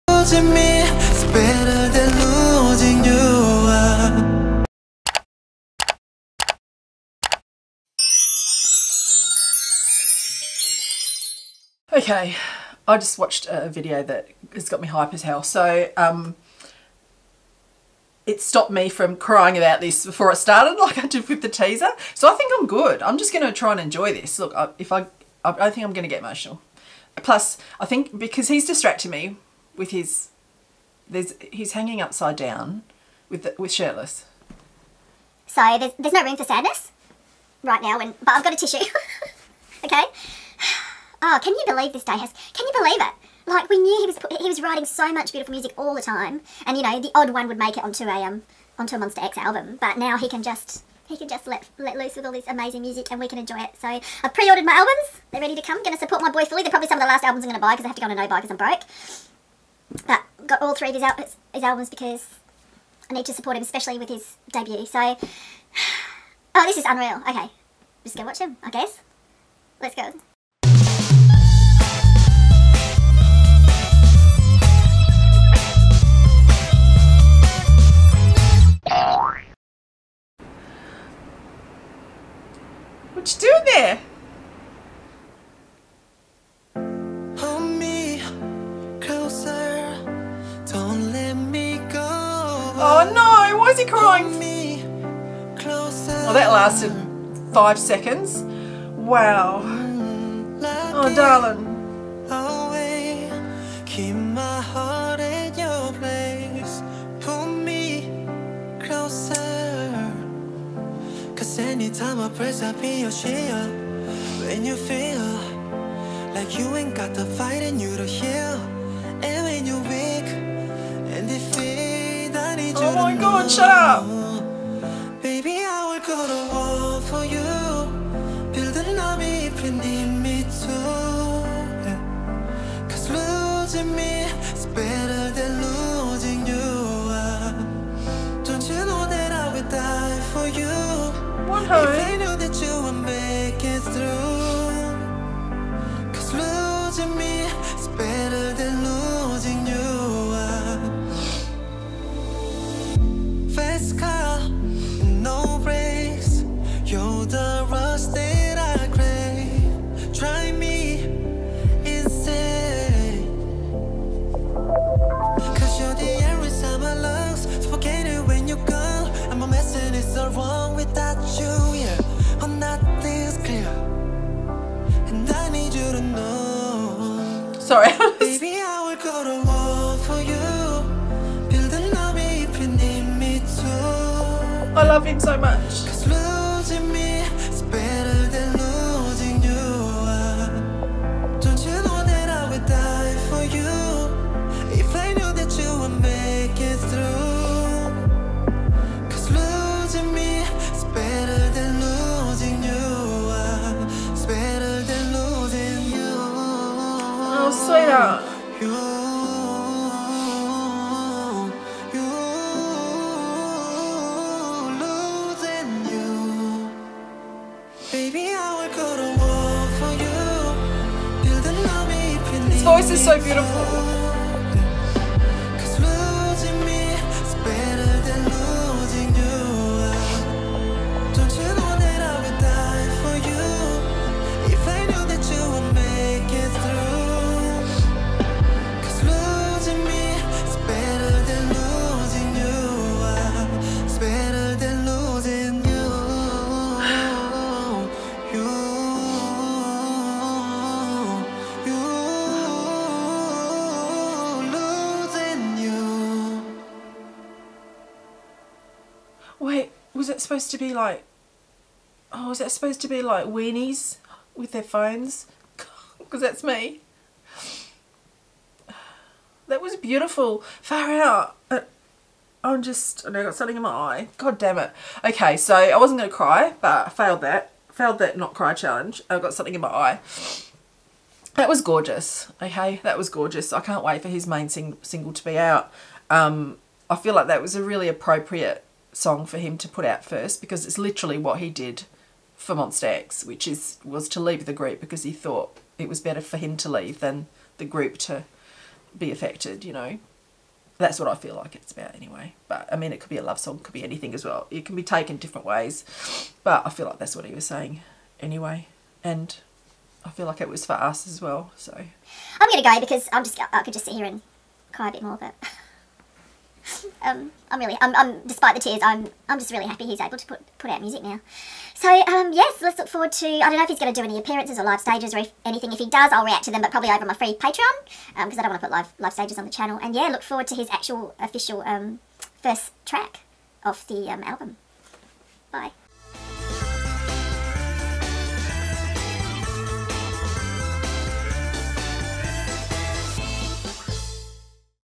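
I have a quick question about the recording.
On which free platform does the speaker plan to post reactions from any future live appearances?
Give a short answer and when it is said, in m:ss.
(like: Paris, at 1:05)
Patreon, at 5:27.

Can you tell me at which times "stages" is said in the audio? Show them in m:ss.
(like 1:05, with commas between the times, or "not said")
5:24, 5:29.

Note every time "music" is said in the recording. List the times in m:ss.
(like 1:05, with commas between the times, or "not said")
0:45, 0:52, 5:20.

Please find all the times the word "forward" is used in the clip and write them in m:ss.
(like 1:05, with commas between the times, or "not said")
5:22, 5:30.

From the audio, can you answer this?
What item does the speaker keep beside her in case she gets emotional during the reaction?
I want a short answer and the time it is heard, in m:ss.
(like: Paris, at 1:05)
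a tissue, at 0:38.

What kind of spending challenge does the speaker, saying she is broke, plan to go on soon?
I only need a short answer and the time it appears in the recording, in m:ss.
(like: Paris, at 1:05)
a no buy, at 0:58.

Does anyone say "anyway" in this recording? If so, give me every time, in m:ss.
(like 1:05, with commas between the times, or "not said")
5:01, 5:08.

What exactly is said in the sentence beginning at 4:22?
Oh, was it supposed to be like Wenees with their phones?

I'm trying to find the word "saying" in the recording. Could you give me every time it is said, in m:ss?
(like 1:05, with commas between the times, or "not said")
5:07.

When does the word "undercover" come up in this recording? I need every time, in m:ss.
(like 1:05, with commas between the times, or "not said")
not said.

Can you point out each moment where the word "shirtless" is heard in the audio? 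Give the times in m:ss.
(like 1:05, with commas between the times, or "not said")
0:33.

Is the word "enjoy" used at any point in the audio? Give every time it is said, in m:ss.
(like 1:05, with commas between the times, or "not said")
0:23, 0:53.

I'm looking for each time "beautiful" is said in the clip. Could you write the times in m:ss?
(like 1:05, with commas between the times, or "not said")
0:45, 4:29.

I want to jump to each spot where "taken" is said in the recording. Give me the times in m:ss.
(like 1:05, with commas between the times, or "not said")
5:04.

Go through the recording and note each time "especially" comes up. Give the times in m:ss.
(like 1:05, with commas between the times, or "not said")
1:03.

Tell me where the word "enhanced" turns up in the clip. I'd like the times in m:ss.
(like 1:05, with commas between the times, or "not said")
not said.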